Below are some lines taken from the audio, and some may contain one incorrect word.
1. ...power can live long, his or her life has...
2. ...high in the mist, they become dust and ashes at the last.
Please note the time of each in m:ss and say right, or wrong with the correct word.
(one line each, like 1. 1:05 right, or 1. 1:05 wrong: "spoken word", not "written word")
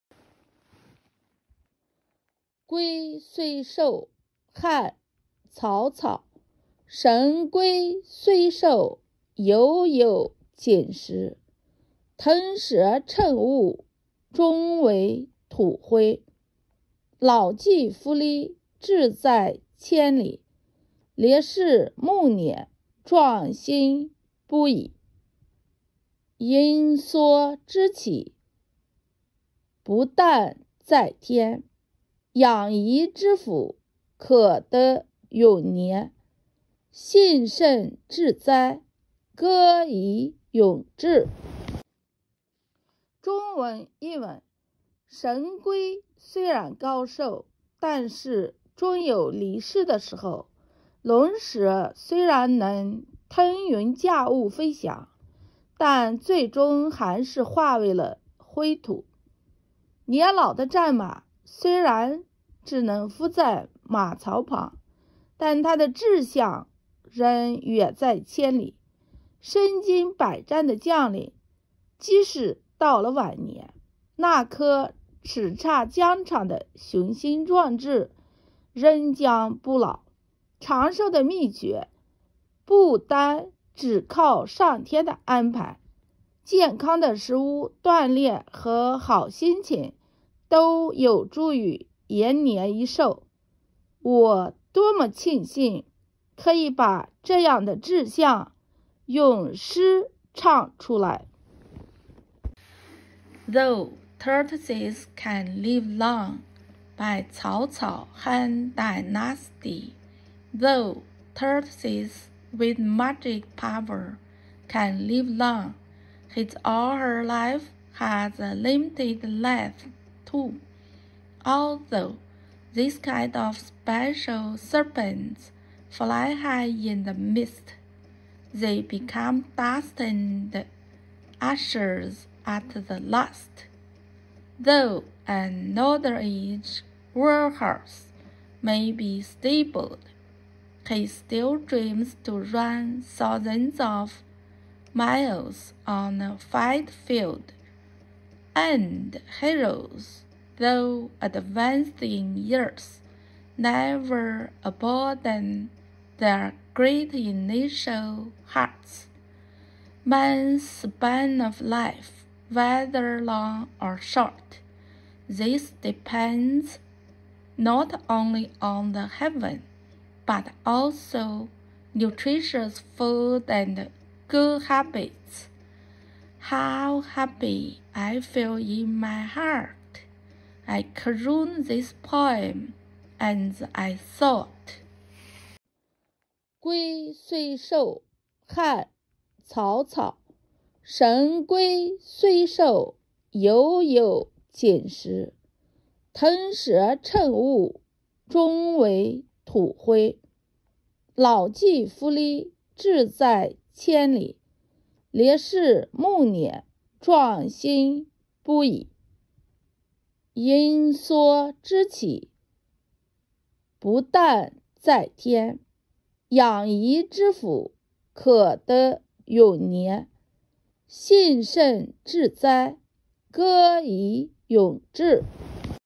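1. 1:53 right
2. 2:06 right.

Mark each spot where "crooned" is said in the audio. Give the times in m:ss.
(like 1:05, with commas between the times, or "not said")
3:00.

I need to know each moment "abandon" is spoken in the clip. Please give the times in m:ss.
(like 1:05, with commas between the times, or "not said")
2:34.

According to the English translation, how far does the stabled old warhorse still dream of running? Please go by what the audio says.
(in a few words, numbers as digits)
thousands of miles.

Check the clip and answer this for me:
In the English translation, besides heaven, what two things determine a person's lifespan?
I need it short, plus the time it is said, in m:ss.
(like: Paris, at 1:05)
nutritious food and good habits, at 2:51.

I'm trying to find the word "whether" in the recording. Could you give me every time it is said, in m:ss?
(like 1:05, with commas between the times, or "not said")
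2:42.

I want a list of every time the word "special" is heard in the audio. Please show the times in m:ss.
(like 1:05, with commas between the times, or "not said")
2:03.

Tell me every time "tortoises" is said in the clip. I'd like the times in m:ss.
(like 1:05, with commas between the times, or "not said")
1:44, 1:51.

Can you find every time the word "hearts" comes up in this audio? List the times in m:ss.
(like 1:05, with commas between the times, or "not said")
2:38, 2:59.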